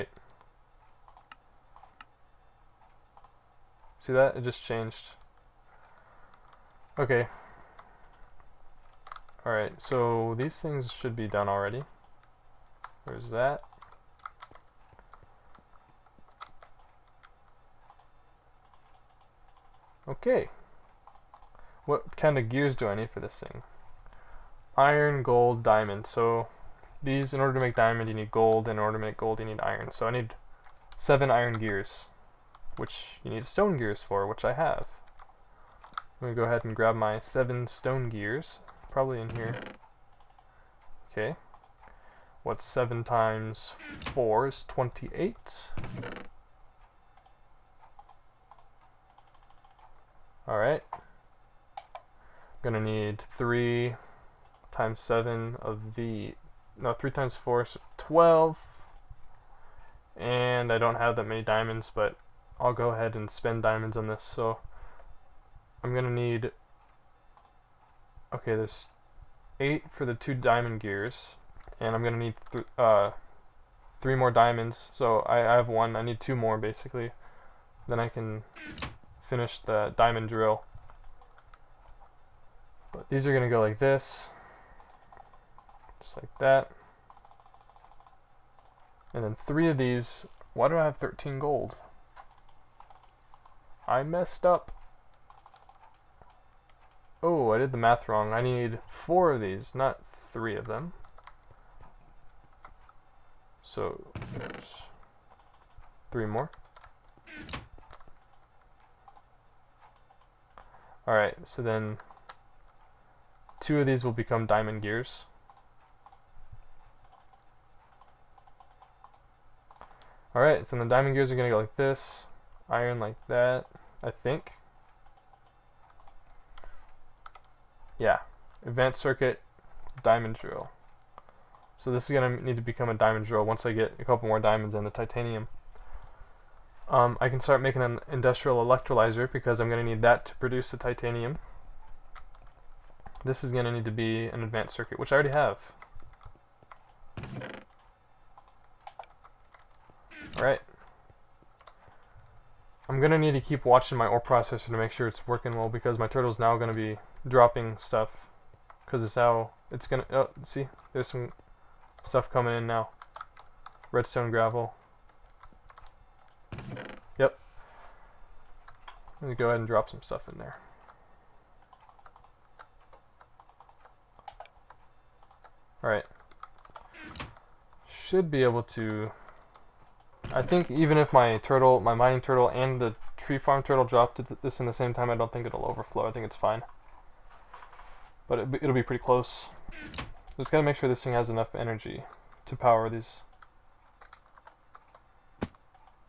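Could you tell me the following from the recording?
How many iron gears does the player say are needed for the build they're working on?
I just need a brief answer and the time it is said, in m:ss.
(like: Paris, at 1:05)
7, at 0:30.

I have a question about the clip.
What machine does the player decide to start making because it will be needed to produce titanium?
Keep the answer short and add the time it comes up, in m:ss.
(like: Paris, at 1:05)
industrial electrolyzer, at 2:18.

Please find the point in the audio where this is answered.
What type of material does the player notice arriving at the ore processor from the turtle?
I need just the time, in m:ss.
2:43.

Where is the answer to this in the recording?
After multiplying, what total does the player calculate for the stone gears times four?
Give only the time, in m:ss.
0:44.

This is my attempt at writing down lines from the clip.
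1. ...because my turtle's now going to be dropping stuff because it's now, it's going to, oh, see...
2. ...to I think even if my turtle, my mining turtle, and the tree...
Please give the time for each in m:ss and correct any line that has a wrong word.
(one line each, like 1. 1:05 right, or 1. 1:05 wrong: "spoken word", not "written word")
1. 2:35 right
2. 2:58 right.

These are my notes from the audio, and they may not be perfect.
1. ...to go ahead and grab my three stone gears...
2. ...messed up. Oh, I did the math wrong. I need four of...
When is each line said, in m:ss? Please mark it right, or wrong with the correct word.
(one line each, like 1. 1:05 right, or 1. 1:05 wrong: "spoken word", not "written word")
1. 0:36 wrong: "seven", not "three"
2. 1:34 right.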